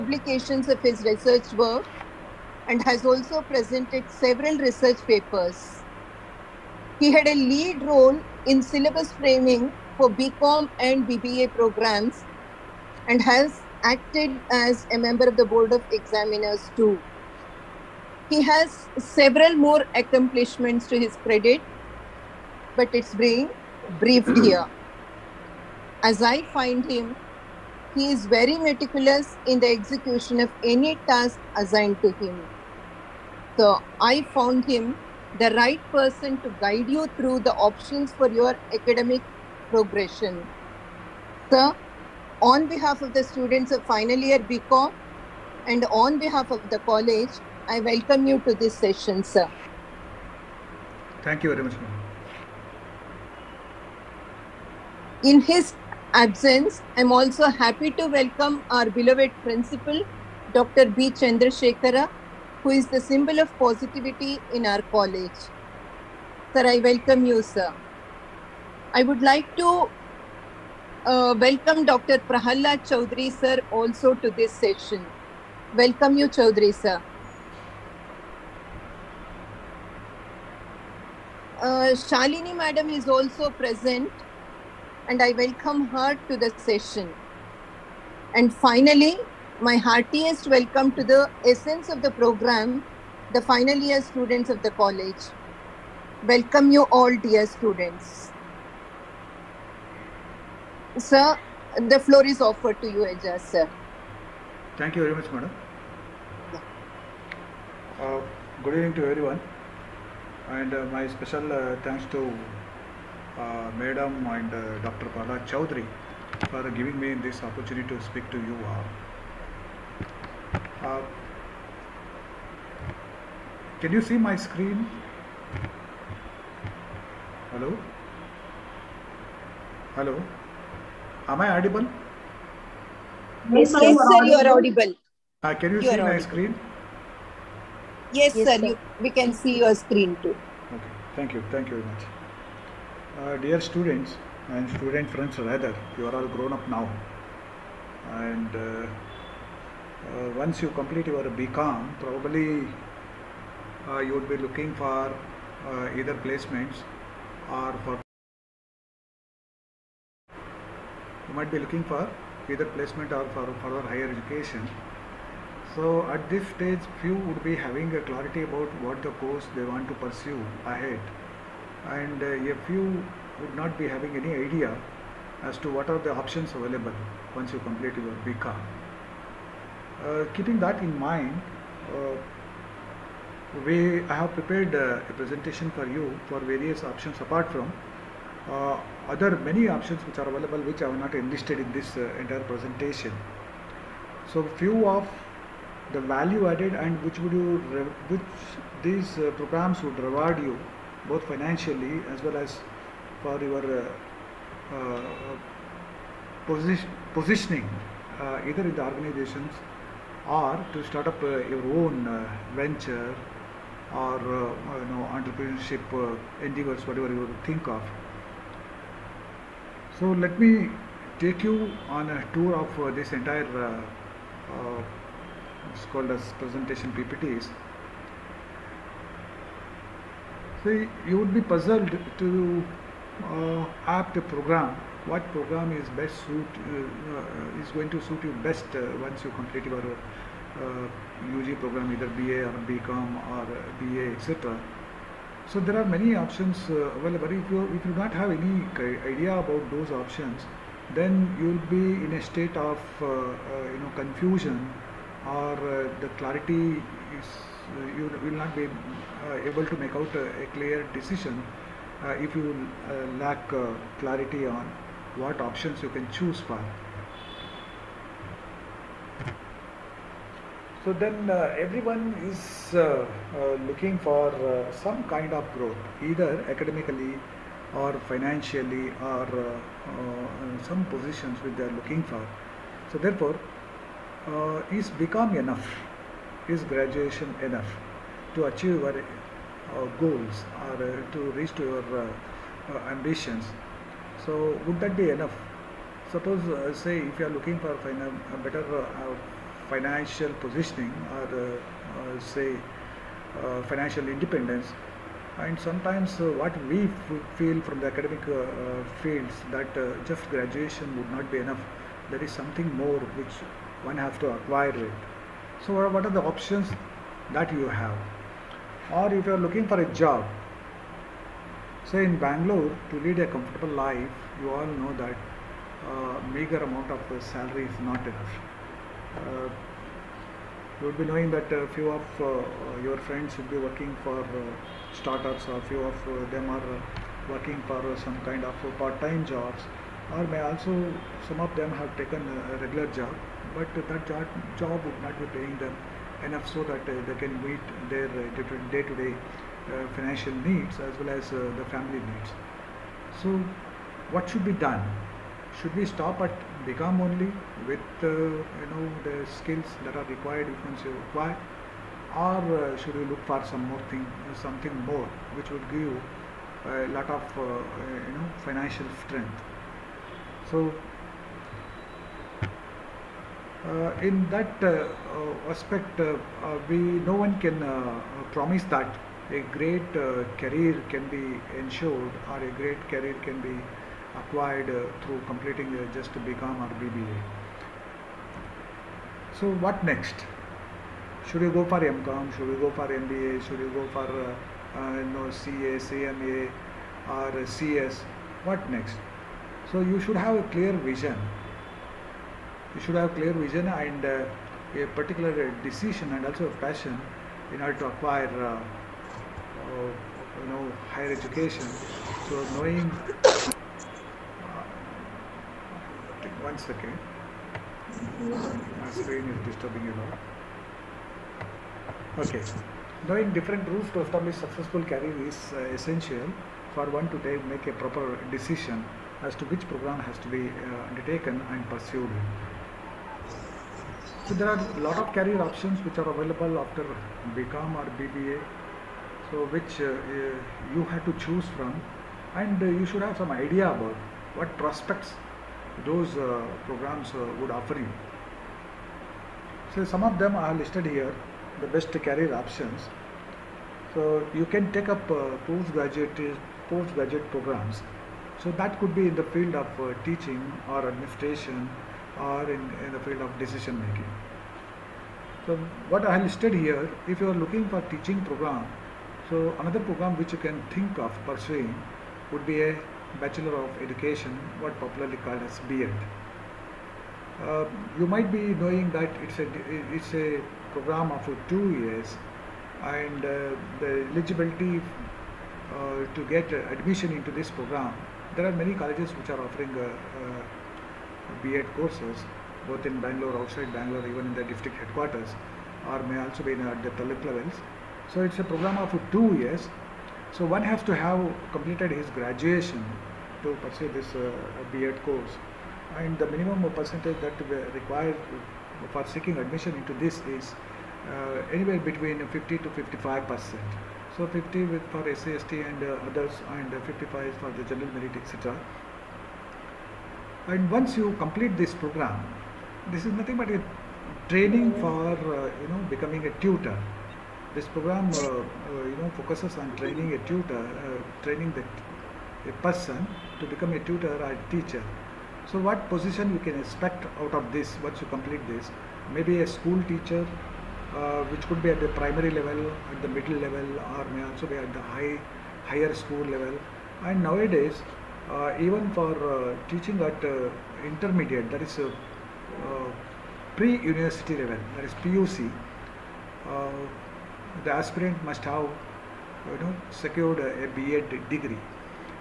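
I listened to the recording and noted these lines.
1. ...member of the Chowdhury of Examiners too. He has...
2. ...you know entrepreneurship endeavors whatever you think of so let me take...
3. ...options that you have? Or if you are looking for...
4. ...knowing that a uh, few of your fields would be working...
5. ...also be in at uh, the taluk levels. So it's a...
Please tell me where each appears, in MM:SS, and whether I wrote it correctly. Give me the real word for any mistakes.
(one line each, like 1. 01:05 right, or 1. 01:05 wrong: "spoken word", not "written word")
1. 00:14 wrong: "Board", not "Chowdhury"
2. 03:34 right
3. 05:16 right
4. 05:31 wrong: "friends", not "fields"
5. 08:16 right.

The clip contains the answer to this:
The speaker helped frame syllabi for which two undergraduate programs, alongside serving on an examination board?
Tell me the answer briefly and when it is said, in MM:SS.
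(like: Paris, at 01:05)
BCom and BBA, at 00:10.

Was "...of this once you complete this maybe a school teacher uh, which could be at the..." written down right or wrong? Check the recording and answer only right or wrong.
right.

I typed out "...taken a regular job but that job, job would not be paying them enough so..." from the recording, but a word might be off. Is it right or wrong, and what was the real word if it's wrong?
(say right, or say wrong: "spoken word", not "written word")
right.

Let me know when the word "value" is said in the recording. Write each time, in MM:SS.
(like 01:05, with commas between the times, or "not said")
03:16.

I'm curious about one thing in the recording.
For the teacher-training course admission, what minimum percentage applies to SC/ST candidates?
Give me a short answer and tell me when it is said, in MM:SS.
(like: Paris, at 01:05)
50 percent, at 08:34.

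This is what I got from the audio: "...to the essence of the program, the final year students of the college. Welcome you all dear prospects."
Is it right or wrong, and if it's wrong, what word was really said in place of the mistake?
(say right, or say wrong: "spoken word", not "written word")
wrong: "students", not "prospects".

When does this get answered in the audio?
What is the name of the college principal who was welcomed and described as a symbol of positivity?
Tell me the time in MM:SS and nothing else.
01:01.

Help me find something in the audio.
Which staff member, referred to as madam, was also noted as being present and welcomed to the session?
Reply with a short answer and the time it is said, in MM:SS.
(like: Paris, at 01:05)
Shalini, at 01:22.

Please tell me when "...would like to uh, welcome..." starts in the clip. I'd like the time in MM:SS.
01:09.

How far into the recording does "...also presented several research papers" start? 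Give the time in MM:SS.
00:03.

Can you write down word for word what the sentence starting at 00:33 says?
So I found him the right person to guide you through the options for your academic progression.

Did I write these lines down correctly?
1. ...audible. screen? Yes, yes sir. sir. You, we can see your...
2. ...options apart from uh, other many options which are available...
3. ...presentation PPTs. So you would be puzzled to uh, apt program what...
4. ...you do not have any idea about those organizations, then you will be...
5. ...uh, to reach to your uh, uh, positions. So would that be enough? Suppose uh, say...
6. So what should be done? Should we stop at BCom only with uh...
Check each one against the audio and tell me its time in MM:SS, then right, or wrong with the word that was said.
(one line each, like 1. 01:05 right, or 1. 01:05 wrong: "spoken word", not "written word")
1. 02:16 right
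2. 03:06 right
3. 03:46 right
4. 04:07 wrong: "options", not "organizations"
5. 04:50 wrong: "ambitions", not "positions"
6. 05:53 right.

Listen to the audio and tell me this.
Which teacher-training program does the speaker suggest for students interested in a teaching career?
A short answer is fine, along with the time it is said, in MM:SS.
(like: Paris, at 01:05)
Bachelor of Education, at 07:53.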